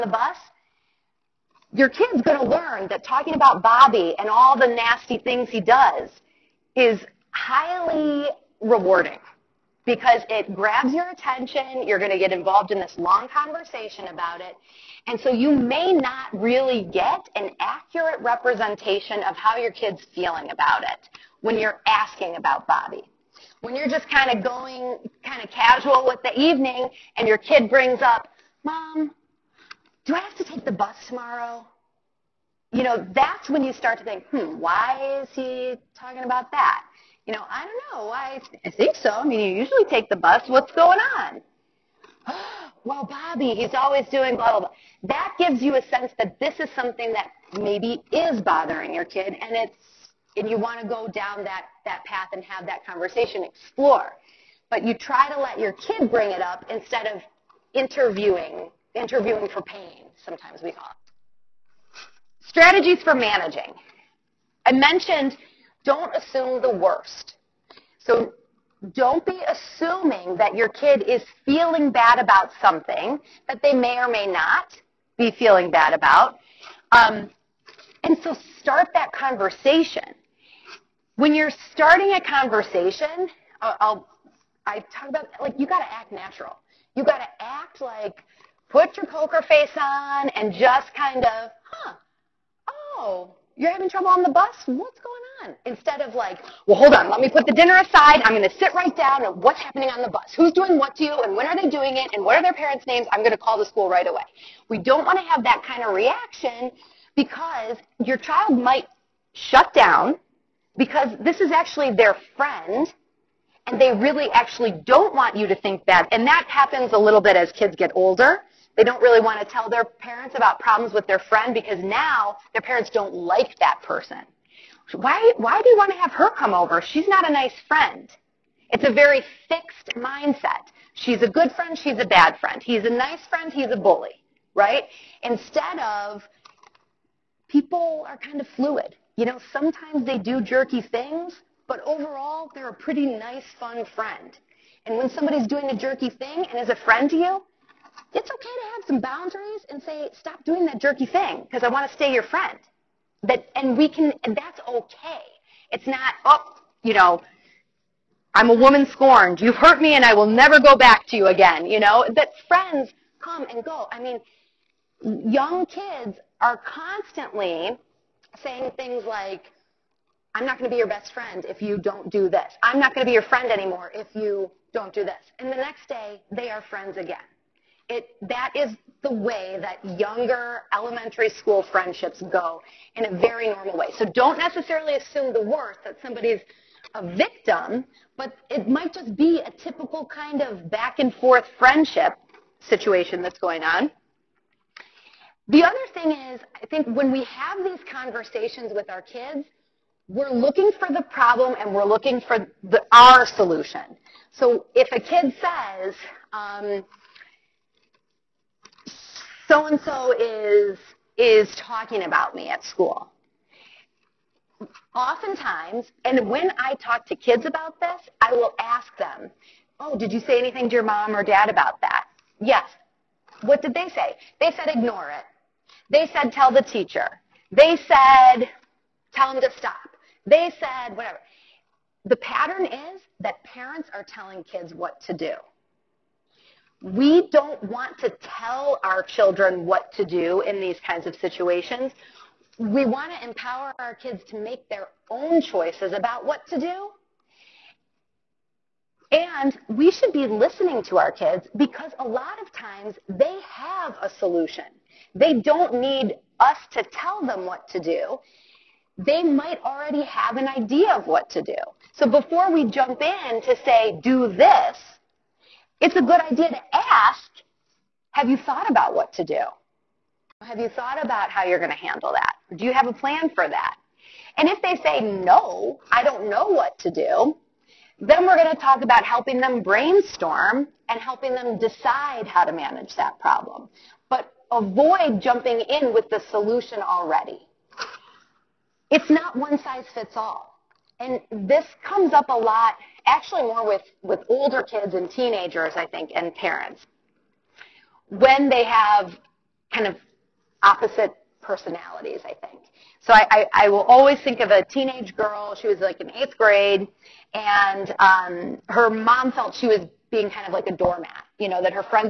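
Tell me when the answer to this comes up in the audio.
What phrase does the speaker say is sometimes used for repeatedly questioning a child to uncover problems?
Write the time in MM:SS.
00:58.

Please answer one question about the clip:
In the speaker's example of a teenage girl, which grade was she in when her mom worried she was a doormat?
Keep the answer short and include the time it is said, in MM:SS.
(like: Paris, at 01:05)
eighth grade, at 05:06.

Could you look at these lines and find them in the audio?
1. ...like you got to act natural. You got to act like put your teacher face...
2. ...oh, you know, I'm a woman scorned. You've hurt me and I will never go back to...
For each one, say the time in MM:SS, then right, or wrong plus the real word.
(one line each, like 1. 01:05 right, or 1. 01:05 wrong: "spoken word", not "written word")
1. 01:25 wrong: "poker", not "teacher"
2. 02:36 right.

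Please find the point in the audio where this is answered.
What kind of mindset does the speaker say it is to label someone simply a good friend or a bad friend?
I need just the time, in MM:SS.
02:09.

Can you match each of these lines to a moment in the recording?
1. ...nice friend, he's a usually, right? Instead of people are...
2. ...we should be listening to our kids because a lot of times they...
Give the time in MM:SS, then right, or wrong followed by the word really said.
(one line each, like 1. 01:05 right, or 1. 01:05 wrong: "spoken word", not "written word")
1. 02:12 wrong: "bully", not "usually"
2. 04:09 right.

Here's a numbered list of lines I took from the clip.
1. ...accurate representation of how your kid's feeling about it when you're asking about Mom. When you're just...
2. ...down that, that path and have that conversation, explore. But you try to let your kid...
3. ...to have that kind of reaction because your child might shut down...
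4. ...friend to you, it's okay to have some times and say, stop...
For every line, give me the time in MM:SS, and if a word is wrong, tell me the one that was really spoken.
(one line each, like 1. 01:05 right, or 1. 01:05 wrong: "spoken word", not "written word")
1. 00:17 wrong: "Bobby", not "Mom"
2. 00:51 right
3. 01:45 right
4. 02:26 wrong: "boundaries", not "times".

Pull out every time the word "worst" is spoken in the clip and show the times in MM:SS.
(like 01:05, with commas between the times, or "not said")
01:06, 03:05.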